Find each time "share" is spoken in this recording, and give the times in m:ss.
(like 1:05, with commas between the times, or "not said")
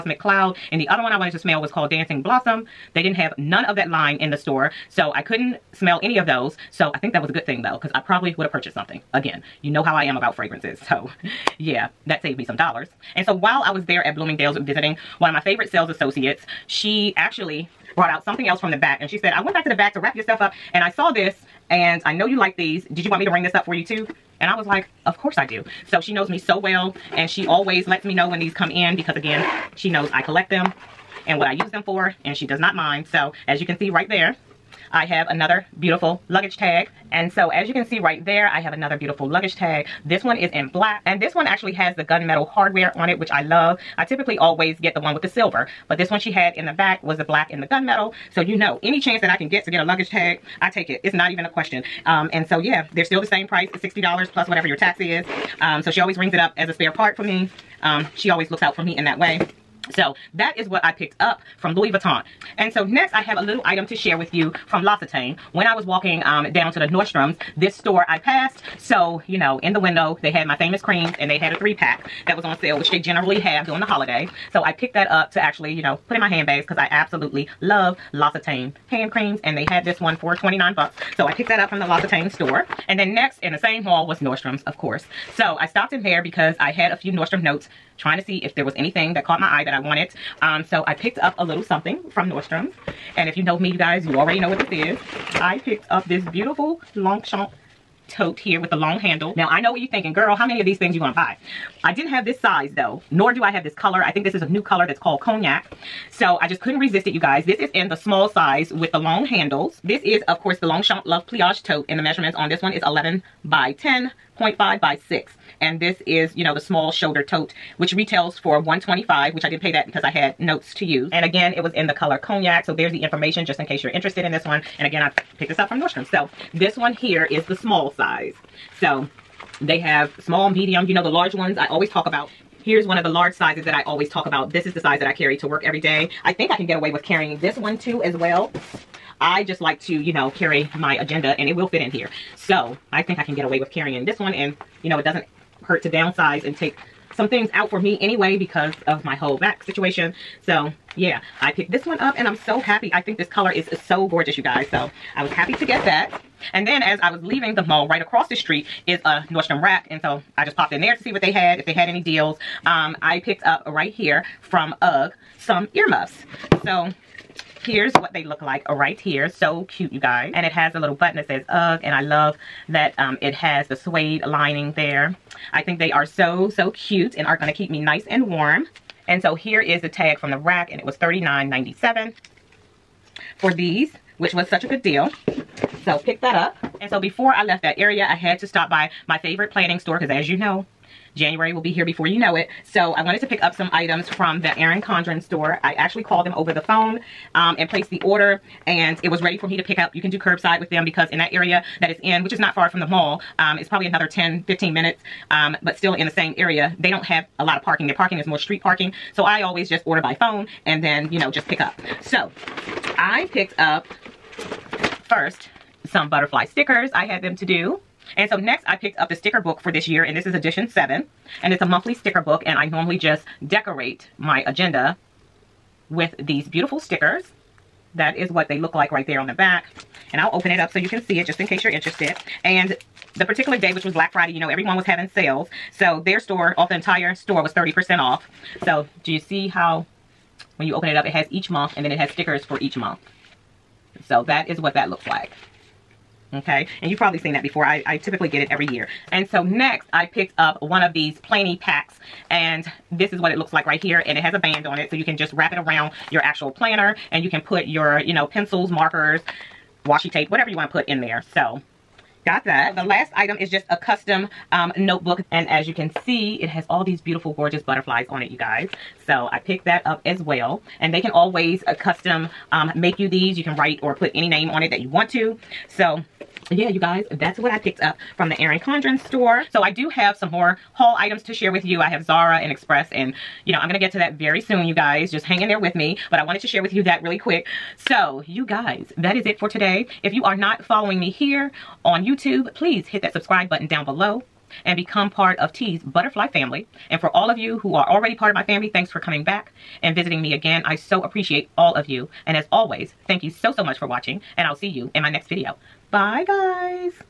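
1:03, 4:41, 4:46.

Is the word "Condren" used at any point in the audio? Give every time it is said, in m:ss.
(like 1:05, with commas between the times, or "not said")
3:14, 4:38.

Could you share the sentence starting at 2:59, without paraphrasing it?
And so here is the tag from the rack and it was $39.97 for these, which was such a good deal.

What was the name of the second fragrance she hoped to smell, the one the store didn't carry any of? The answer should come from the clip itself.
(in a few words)
Dancing Blossom.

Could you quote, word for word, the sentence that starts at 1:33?
And if you know me, you guys, you already know what this is.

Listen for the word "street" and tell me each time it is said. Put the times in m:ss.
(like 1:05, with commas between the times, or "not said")
2:38, 3:28.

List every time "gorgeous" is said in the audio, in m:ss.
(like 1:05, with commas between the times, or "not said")
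2:34, 4:27.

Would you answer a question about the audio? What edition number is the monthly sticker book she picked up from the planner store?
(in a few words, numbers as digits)
7.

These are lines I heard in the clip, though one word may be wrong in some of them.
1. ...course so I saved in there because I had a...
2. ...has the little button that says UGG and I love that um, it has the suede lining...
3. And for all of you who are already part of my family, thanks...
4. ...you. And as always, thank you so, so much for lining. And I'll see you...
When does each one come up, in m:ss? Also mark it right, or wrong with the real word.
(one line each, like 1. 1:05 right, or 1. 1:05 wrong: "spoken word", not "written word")
1. 1:24 wrong: "stopped", not "saved"
2. 2:50 right
3. 4:56 right
4. 5:01 wrong: "watching", not "lining".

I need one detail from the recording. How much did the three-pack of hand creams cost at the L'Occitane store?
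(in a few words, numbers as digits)
$29.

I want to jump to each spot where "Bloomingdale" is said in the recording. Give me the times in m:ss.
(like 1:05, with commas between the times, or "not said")
0:14.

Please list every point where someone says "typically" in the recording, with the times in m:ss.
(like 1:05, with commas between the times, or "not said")
0:44, 4:08.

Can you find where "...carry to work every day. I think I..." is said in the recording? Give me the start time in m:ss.
2:15.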